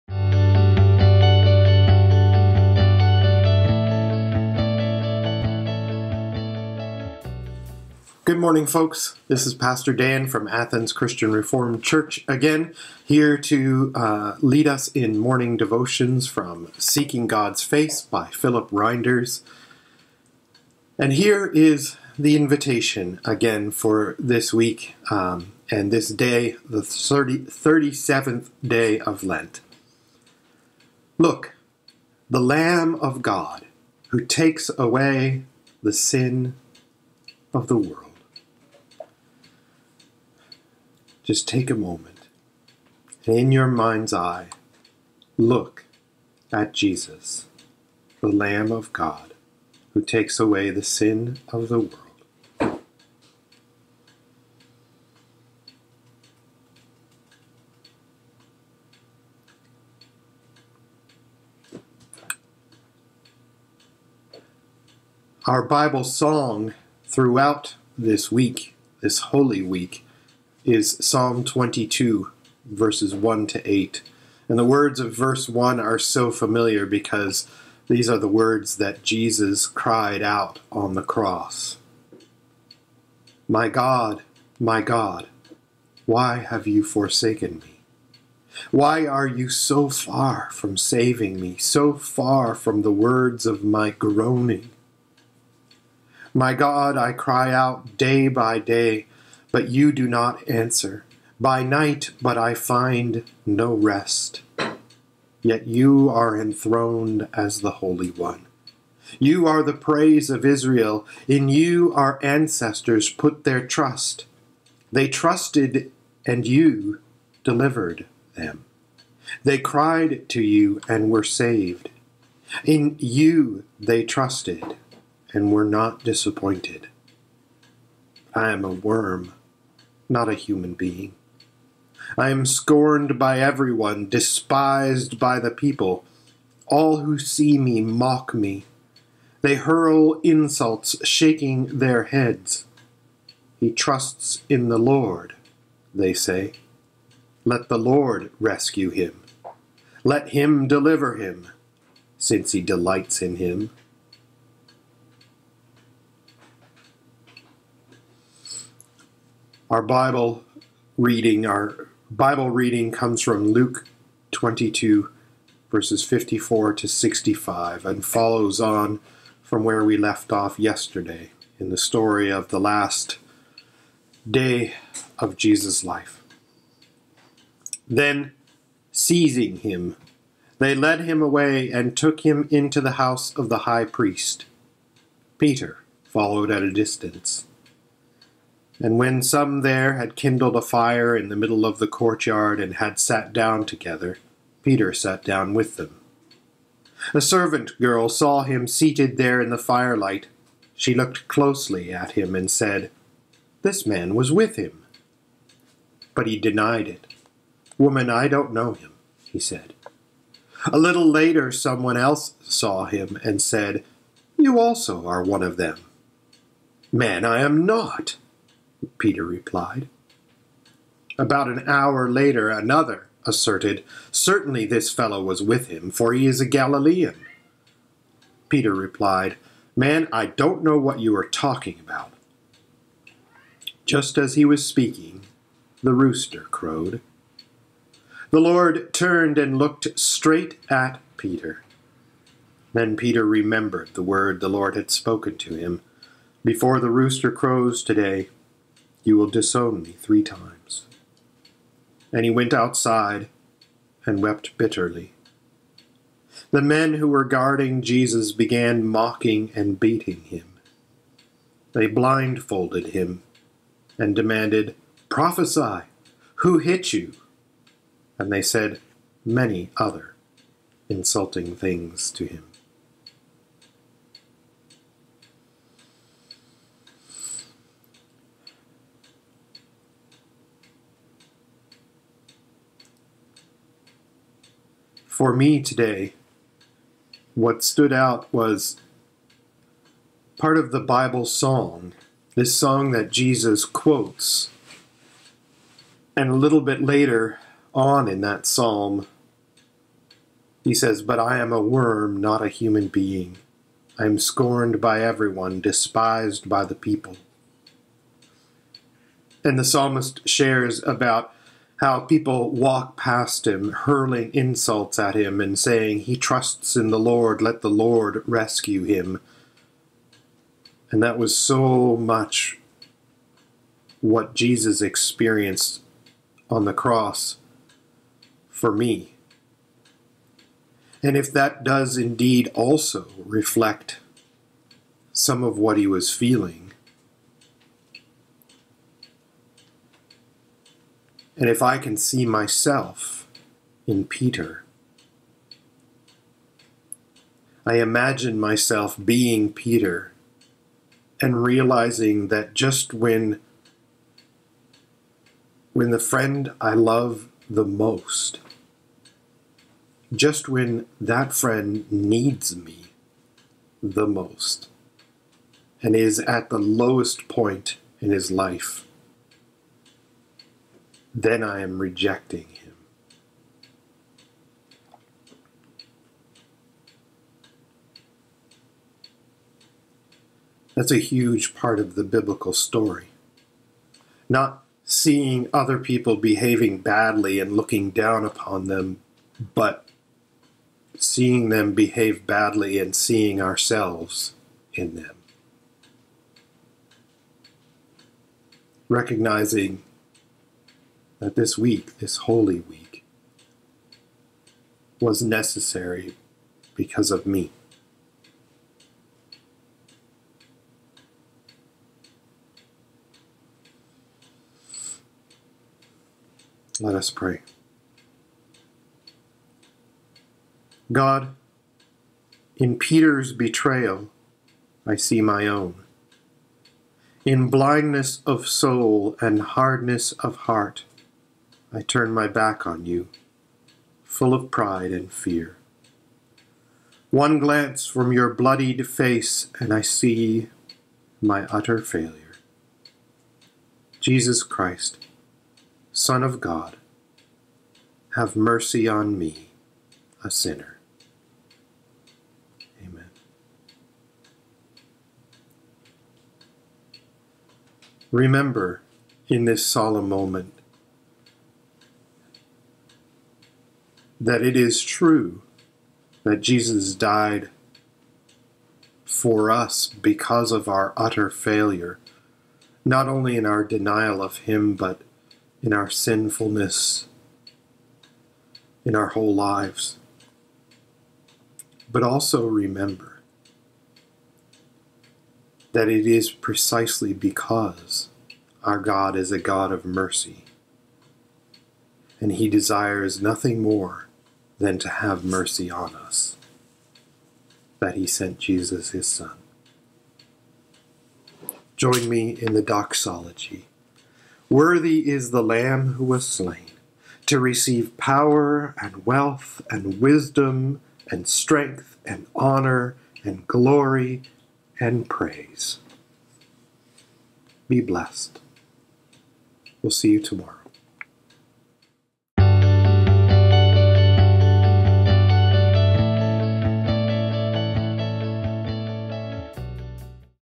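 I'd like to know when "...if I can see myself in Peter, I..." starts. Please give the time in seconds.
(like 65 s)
341 s.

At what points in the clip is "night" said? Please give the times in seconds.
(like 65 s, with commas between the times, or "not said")
101 s.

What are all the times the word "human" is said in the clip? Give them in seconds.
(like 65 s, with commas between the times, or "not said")
130 s, 302 s.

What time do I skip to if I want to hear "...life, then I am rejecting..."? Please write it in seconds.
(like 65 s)
368 s.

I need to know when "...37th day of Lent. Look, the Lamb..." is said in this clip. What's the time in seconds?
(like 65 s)
27 s.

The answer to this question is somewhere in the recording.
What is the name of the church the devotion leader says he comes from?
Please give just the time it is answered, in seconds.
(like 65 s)
10 s.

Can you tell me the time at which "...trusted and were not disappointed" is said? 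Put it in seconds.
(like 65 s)
124 s.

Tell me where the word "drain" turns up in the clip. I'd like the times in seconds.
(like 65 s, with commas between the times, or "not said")
not said.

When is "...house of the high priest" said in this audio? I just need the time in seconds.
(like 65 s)
182 s.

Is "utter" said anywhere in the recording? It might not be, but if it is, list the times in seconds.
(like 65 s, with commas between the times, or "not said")
441 s, 470 s.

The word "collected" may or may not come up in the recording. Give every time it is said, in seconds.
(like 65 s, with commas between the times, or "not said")
not said.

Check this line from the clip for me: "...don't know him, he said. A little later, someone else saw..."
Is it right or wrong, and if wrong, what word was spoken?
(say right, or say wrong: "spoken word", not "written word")
right.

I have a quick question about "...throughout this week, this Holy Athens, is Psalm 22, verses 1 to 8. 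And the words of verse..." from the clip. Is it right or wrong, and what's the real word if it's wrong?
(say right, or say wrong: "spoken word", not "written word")
wrong: "Week", not "Athens".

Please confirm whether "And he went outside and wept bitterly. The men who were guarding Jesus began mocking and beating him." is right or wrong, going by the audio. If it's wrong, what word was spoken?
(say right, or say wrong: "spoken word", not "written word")
right.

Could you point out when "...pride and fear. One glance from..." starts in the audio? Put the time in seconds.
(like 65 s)
434 s.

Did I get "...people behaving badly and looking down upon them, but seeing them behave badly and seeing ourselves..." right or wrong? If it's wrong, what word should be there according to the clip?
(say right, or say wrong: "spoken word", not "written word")
right.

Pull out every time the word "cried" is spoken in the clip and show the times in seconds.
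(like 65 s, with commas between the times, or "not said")
79 s, 119 s.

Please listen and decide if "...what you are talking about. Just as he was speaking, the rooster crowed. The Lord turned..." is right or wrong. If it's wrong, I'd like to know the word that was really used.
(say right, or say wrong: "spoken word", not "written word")
right.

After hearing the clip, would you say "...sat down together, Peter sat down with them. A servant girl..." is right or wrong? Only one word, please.
right.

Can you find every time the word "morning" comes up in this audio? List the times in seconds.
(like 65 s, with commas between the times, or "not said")
8 s, 15 s.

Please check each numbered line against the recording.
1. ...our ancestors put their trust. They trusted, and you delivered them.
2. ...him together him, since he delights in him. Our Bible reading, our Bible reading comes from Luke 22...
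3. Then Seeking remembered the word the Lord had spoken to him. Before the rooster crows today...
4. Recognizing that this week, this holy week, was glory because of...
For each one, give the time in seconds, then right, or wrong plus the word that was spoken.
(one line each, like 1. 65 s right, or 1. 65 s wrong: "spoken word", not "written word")
1. 111 s right
2. 150 s wrong: "deliver", not "together"
3. 242 s wrong: "Peter", not "Seeking"
4. 398 s wrong: "necessary", not "glory".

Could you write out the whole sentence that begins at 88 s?
Why are you so far from saving me, so far from the words of my groaning?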